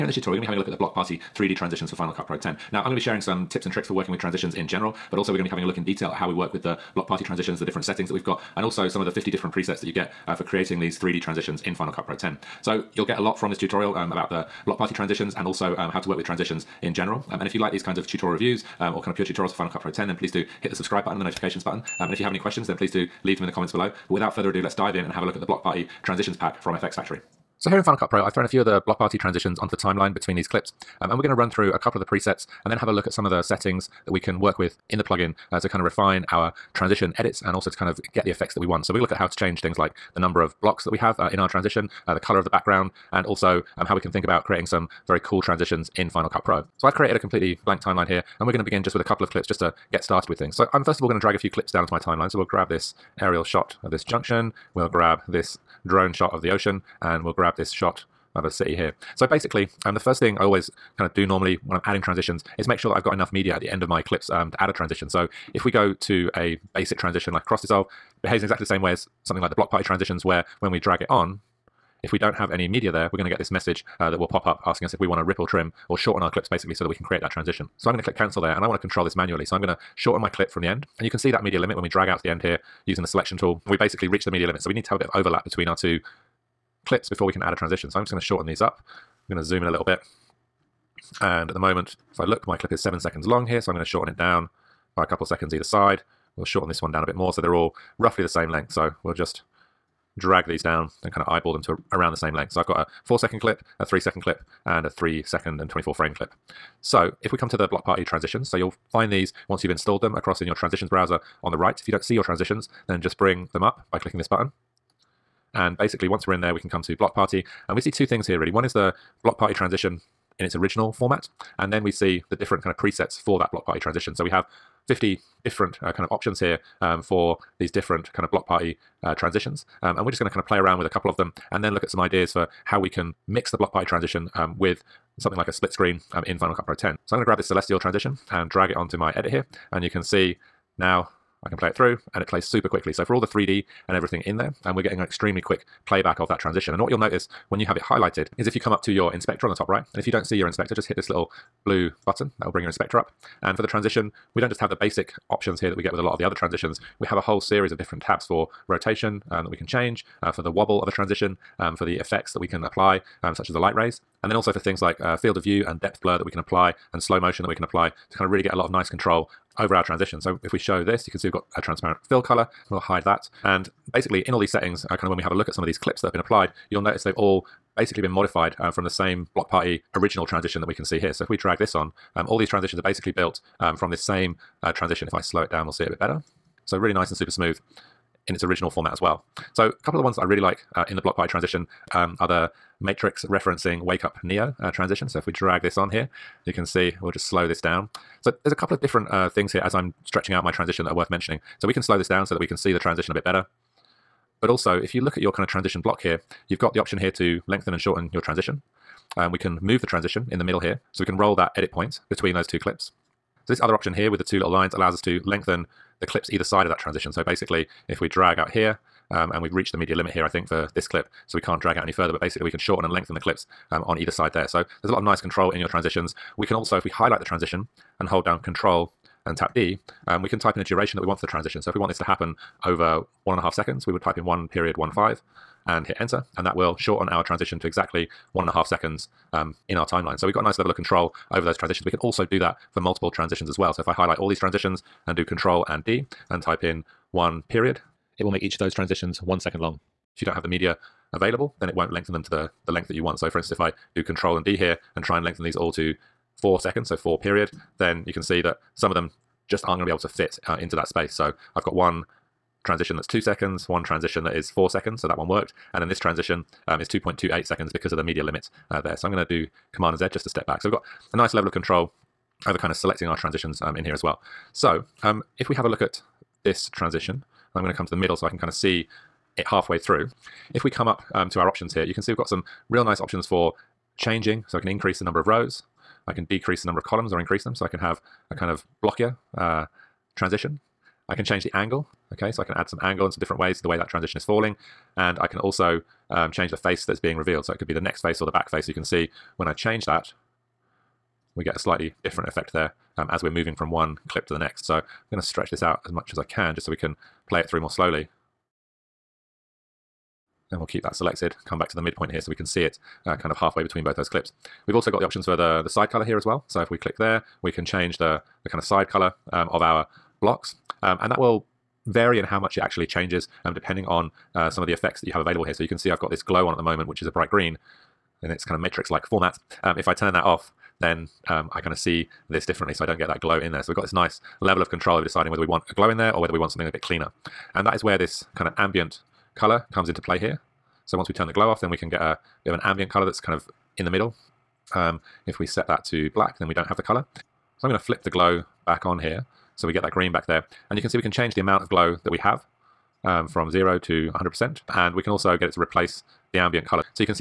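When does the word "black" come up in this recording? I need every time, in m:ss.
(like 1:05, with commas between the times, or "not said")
5:46.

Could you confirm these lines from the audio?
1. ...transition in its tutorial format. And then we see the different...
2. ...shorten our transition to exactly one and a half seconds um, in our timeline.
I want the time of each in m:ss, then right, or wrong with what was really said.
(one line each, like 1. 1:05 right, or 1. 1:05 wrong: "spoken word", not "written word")
1. 1:59 wrong: "original", not "tutorial"
2. 3:56 right.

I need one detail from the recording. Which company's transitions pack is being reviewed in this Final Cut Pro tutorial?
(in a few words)
FxFactory.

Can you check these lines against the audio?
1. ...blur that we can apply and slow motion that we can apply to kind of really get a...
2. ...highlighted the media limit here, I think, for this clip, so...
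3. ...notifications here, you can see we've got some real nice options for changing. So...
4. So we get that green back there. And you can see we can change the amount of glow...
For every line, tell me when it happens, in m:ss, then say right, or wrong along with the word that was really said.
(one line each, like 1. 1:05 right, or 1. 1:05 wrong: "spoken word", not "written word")
1. 2:46 right
2. 3:39 wrong: "reached", not "highlighted"
3. 4:41 wrong: "options", not "notifications"
4. 5:49 right.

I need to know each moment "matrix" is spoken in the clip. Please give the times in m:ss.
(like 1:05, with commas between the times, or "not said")
3:12, 5:28.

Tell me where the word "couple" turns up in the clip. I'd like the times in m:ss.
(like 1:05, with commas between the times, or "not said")
0:31, 0:49, 1:35, 2:10, 3:09, 3:18.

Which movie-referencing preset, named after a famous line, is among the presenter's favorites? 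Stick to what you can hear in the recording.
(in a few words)
Wake up Neo.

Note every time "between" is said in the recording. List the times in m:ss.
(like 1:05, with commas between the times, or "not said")
0:30, 1:25, 3:32, 5:13.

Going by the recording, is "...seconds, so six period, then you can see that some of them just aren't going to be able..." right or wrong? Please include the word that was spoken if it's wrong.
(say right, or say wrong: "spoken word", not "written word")
wrong: "four", not "six".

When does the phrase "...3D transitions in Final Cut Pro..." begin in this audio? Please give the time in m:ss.
0:10.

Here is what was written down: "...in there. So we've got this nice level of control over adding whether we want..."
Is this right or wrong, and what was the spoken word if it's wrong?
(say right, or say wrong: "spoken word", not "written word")
wrong: "deciding", not "adding".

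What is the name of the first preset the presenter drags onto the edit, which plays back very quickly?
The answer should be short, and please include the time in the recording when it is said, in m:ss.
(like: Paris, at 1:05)
Celestial, at 2:17.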